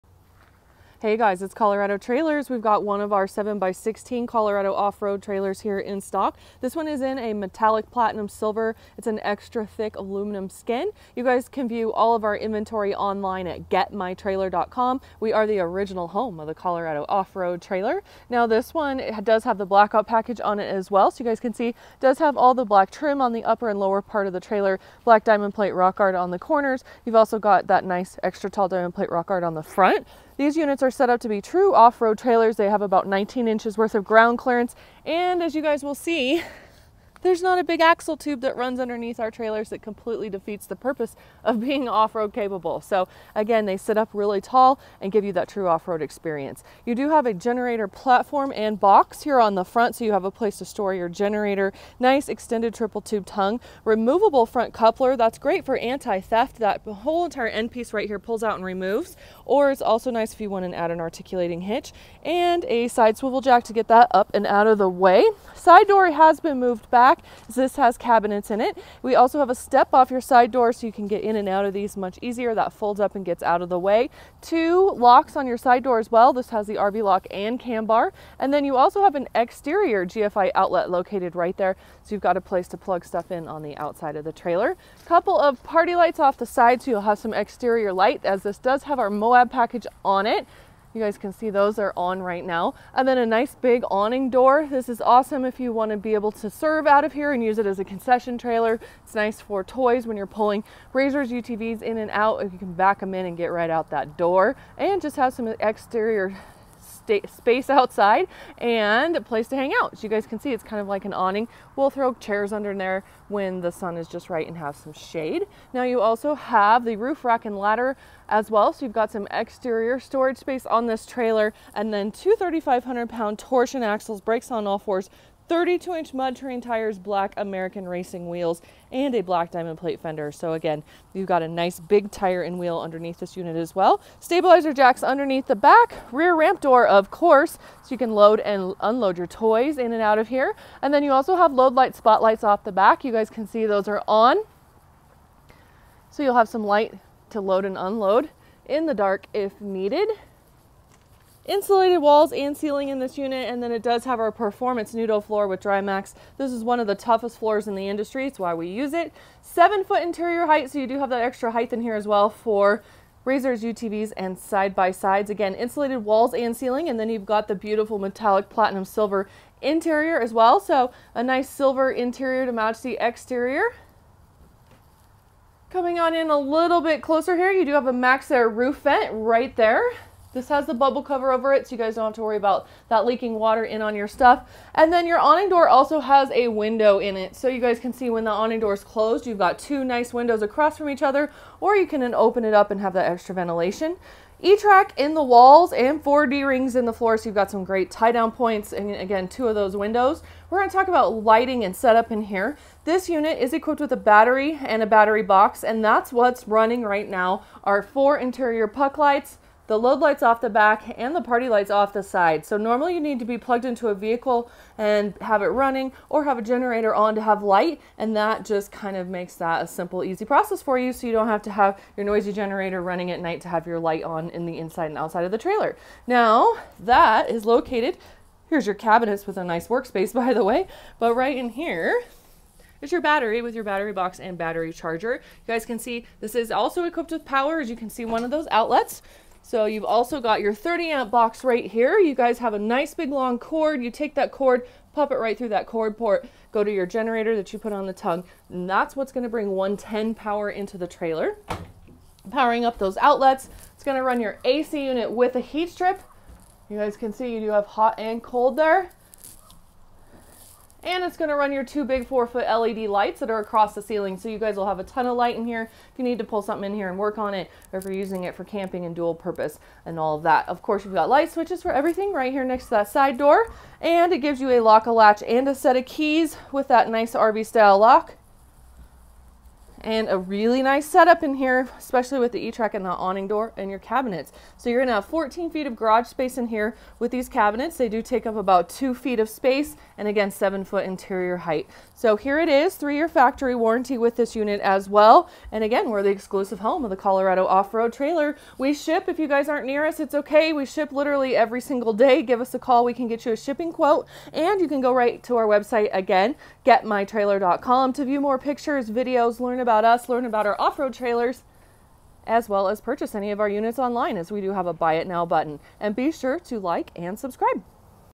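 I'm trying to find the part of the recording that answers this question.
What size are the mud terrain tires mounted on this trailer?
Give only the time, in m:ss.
2:05.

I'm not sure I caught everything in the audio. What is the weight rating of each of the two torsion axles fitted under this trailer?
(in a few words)
3,500 pounds.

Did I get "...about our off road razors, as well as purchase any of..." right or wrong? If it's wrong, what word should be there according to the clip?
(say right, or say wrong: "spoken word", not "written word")
wrong: "trailers", not "razors".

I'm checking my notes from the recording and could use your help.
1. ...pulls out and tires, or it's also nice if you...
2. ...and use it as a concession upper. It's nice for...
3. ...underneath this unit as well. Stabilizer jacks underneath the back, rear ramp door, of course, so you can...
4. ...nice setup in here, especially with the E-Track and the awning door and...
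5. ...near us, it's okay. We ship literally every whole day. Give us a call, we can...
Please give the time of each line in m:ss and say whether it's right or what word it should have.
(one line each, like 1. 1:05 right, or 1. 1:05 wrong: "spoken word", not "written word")
1. 0:58 wrong: "removes", not "tires"
2. 1:37 wrong: "trailer", not "upper"
3. 2:12 right
4. 4:40 right
5. 4:59 wrong: "single", not "whole".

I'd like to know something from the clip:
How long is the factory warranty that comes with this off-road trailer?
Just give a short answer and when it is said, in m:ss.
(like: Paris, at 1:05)
3 years, at 4:52.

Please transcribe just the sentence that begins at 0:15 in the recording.
We are the original home of the Colorado off-road trailer.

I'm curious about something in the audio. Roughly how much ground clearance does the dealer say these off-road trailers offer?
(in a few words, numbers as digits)
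19 inches.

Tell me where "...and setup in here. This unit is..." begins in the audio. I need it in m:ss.
3:21.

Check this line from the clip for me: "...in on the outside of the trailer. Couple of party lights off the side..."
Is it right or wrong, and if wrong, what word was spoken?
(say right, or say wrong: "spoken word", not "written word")
right.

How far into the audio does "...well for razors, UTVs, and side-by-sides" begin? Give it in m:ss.
2:42.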